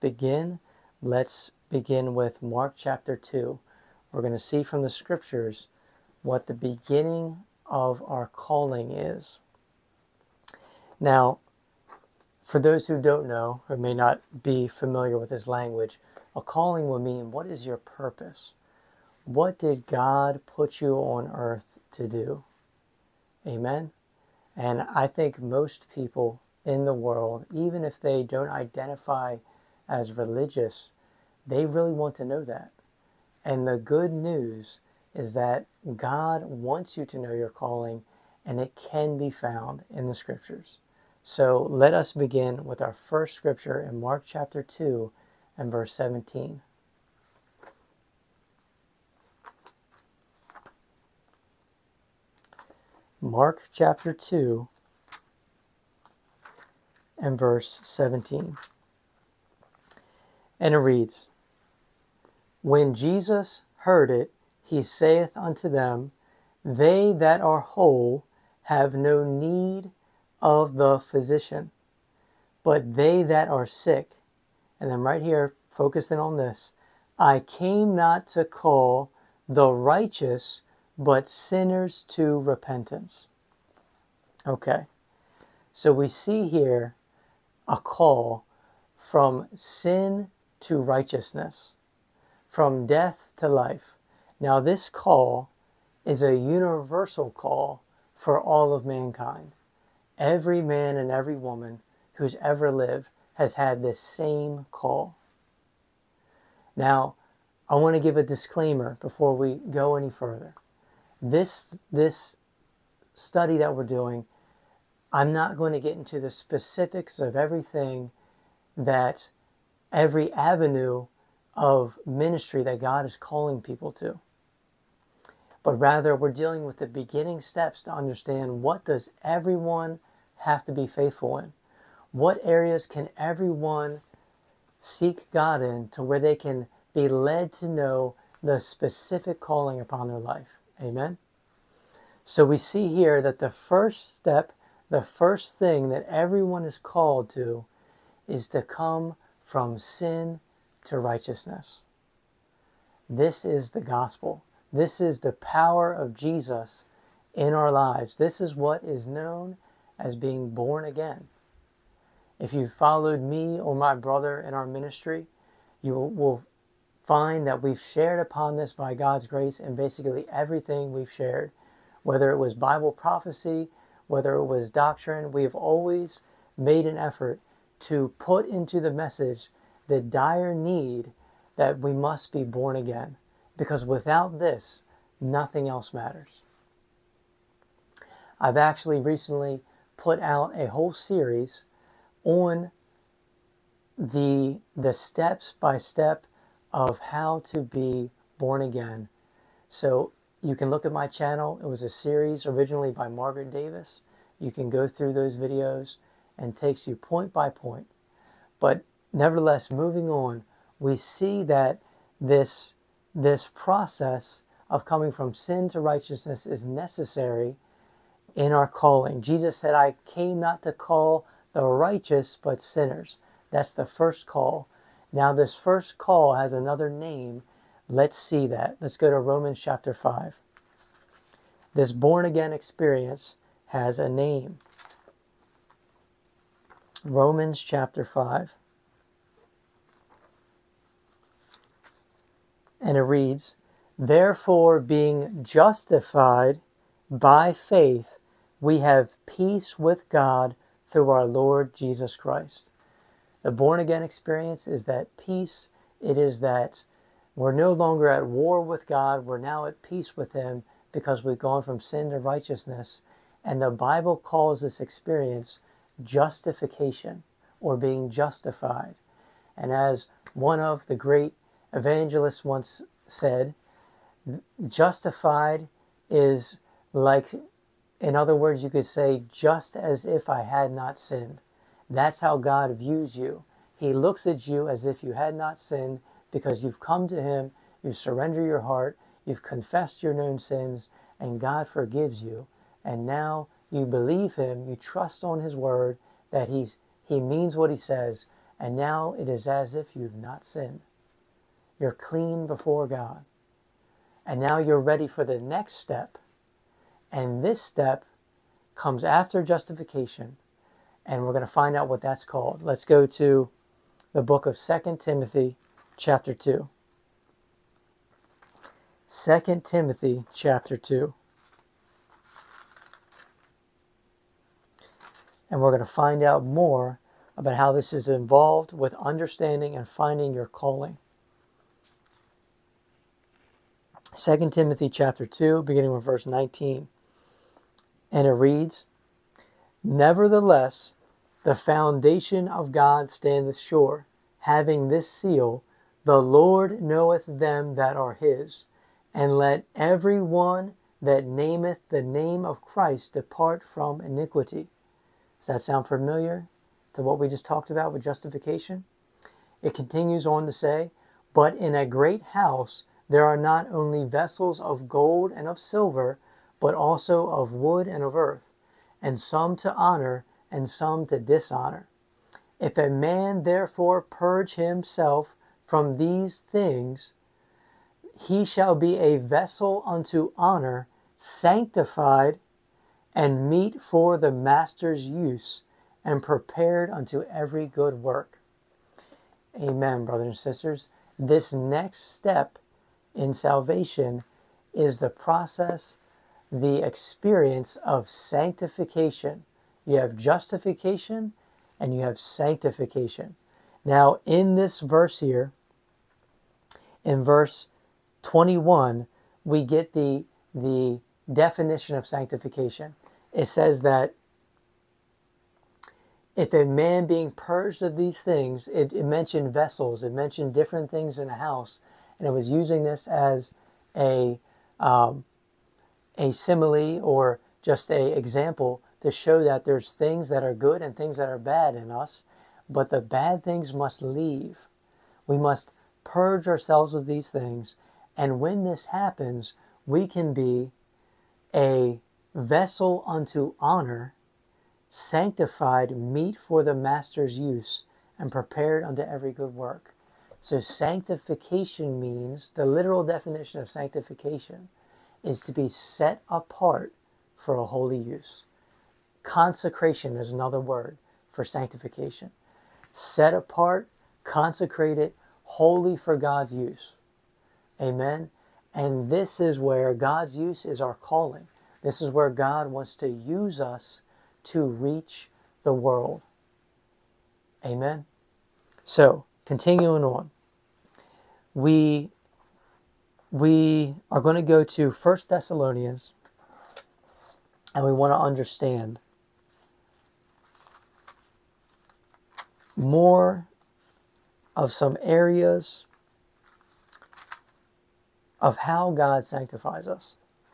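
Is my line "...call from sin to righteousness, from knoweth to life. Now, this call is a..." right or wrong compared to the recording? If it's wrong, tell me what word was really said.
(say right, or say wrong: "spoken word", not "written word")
wrong: "death", not "knoweth".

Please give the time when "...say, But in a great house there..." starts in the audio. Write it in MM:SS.
06:00.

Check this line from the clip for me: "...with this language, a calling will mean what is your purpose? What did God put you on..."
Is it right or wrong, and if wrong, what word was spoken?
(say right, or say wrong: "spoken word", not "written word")
right.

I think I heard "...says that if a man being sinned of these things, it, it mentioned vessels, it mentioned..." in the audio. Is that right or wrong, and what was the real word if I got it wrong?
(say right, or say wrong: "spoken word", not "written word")
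wrong: "purged", not "sinned".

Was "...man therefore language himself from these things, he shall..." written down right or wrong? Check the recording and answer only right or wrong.
wrong.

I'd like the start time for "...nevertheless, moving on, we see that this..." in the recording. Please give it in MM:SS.
03:29.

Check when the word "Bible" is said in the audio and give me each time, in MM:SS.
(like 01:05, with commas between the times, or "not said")
02:52, 04:23.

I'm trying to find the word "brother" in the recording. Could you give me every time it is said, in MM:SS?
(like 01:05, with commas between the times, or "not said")
02:43, 06:30.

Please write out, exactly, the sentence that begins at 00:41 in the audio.
So let us begin with our first scripture in Mark chapter 2 and verse 17.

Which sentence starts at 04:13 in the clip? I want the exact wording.
The born again experience is that peace.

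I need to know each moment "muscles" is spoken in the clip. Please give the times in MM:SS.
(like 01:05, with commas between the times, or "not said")
not said.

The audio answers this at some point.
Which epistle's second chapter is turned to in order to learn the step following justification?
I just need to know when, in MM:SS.
05:14.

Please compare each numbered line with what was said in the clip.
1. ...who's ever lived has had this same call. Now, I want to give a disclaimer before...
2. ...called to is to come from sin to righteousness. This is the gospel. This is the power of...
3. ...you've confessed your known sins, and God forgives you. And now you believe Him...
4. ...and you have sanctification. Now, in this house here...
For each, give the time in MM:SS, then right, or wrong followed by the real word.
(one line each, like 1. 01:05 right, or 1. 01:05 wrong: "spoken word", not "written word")
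1. 01:42 right
2. 02:26 right
3. 04:49 right
4. 06:41 wrong: "verse", not "house".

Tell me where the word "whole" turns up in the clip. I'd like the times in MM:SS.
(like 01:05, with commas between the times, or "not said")
01:07, 03:10.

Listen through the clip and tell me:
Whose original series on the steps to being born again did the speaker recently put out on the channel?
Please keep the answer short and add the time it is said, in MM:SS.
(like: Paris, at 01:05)
Margaret Davis, at 03:23.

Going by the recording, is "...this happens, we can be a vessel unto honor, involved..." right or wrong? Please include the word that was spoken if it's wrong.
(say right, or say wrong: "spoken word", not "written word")
wrong: "sanctified", not "involved".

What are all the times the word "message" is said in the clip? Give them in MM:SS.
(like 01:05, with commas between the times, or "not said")
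02:58.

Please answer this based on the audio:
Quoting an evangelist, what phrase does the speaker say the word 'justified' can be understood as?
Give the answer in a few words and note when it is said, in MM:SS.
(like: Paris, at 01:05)
just as if I had not sinned, at 04:39.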